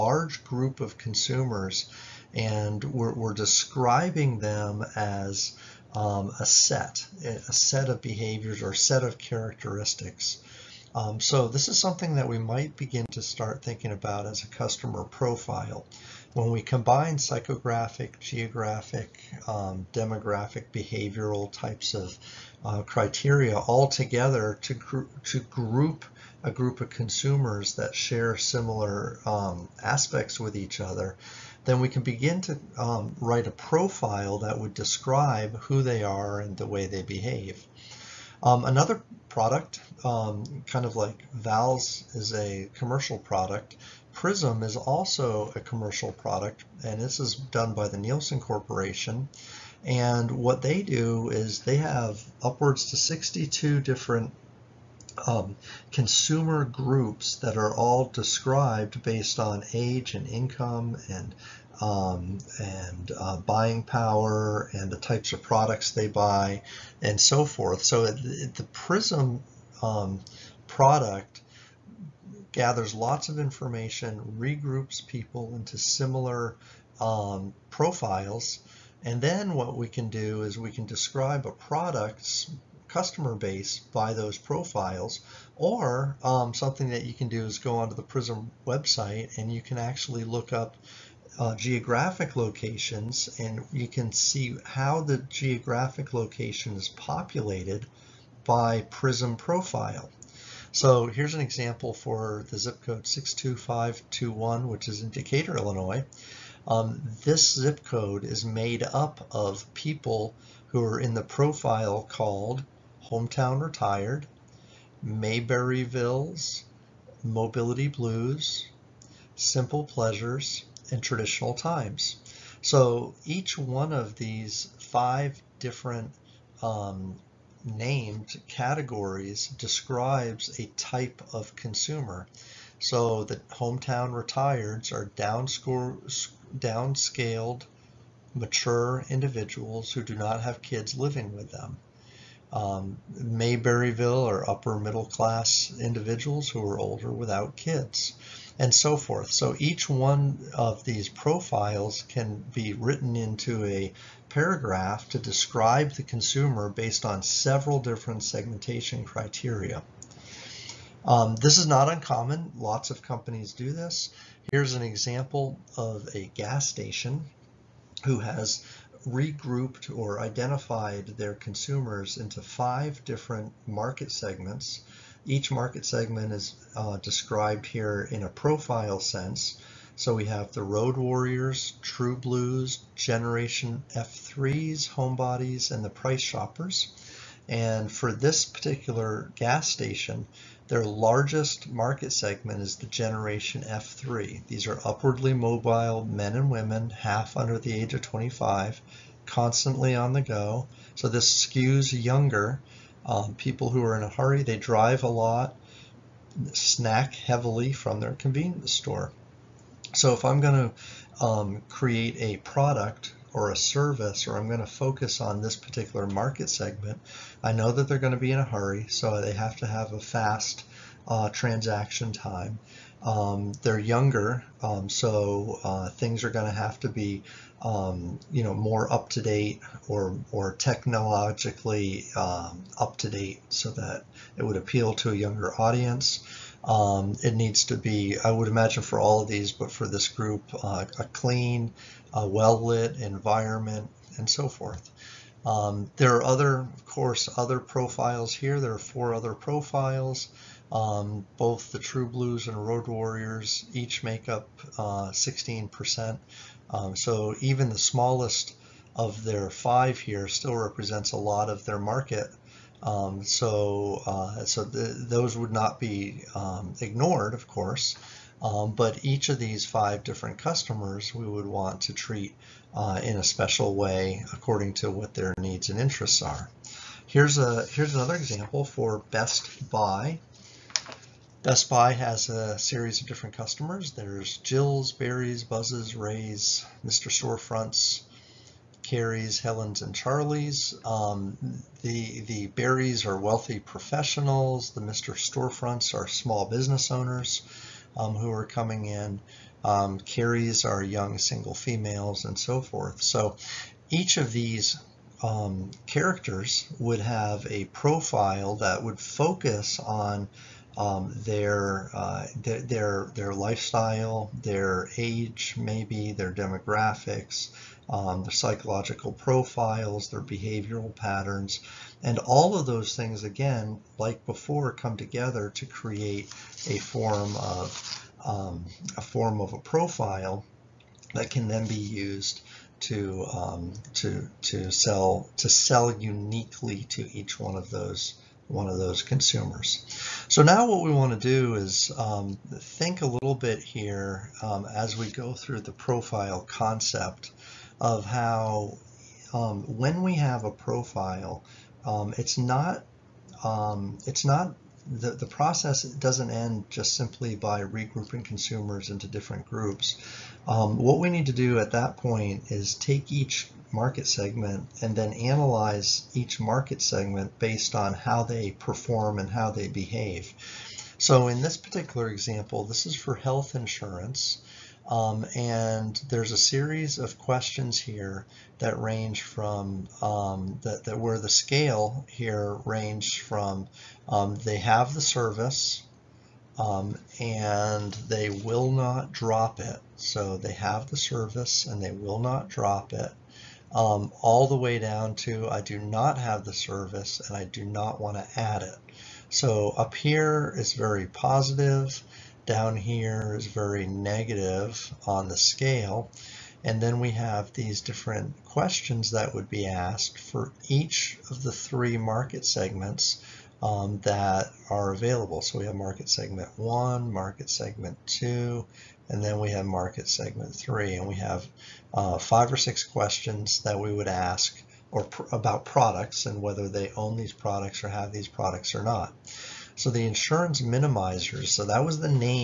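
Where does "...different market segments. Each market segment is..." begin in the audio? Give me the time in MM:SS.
02:53.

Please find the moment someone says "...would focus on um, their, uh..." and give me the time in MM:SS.
05:08.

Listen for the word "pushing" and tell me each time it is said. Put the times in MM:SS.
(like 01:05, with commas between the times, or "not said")
not said.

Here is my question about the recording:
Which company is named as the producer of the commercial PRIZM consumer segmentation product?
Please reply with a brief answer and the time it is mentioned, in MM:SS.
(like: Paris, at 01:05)
Nielsen Corporation, at 00:47.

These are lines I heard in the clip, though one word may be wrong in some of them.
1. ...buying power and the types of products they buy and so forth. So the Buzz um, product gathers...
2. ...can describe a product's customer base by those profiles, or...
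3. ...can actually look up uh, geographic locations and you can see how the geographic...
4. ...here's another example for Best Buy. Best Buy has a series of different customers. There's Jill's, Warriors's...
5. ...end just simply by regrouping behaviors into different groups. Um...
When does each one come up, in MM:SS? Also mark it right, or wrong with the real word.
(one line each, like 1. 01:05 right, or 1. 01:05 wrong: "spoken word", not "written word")
1. 01:03 wrong: "PRIZM", not "Buzz"
2. 01:20 right
3. 01:29 right
4. 04:37 wrong: "Barry", not "Warriors"
5. 05:56 wrong: "consumers", not "behaviors".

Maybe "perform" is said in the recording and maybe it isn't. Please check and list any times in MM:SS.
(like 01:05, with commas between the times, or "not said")
06:08.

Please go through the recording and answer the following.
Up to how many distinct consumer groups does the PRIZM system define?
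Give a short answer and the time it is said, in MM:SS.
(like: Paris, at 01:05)
62, at 00:52.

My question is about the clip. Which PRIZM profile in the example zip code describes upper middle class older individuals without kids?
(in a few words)
Mayberryvilles.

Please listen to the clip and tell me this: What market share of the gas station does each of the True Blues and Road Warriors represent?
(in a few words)
16%.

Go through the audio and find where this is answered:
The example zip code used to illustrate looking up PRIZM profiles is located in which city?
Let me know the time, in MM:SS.
01:45.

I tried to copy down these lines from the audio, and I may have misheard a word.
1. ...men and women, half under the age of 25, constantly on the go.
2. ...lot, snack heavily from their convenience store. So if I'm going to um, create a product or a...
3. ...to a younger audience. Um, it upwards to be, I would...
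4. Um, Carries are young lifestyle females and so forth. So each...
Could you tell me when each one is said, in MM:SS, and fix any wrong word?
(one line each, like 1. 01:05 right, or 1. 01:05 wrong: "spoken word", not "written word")
1. 03:16 right
2. 03:25 right
3. 03:54 wrong: "needs", not "upwards"
4. 04:59 wrong: "single", not "lifestyle".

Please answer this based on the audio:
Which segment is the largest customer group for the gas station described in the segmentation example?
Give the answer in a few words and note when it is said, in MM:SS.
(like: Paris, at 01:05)
Generation F3, at 03:12.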